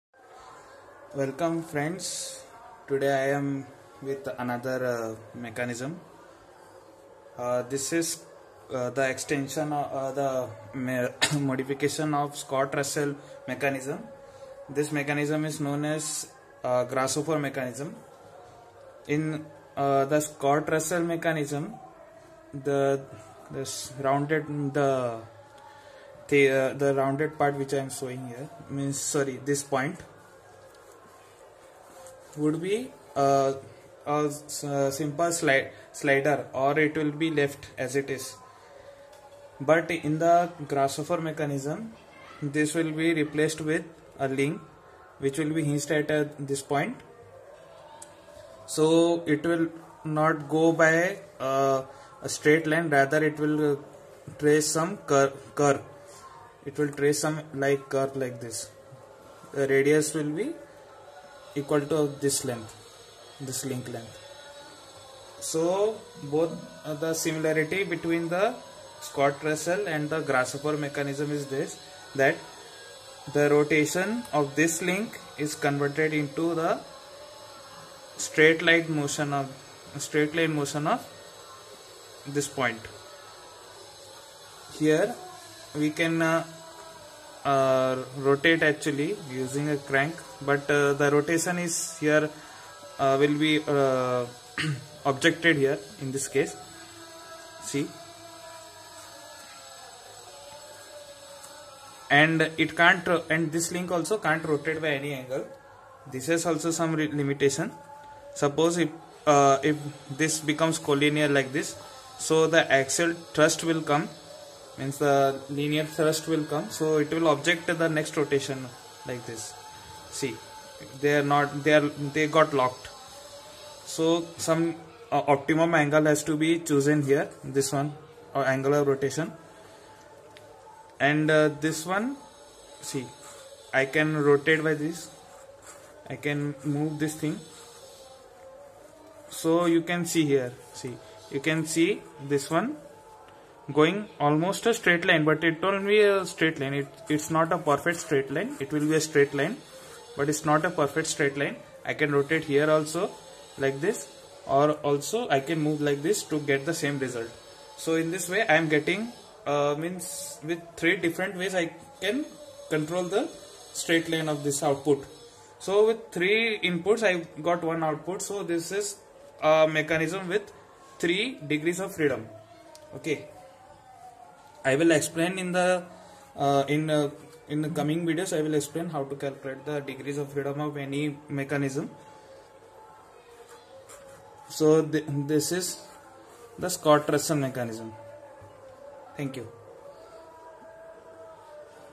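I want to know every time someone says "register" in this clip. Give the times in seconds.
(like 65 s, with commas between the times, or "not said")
not said.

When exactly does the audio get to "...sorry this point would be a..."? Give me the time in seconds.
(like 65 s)
28 s.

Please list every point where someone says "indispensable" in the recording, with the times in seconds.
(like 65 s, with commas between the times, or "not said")
not said.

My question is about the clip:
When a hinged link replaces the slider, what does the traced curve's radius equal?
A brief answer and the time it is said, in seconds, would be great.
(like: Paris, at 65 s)
this link length, at 63 s.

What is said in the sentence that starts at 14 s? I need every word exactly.
This mechanism is known as uh, grasshopper mechanism.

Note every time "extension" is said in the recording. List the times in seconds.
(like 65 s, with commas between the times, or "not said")
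9 s.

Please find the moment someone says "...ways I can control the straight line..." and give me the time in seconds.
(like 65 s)
161 s.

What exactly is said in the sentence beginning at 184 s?
So th this is the Scott-Russell mechanism.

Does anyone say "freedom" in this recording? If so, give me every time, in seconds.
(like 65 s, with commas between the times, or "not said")
171 s, 180 s.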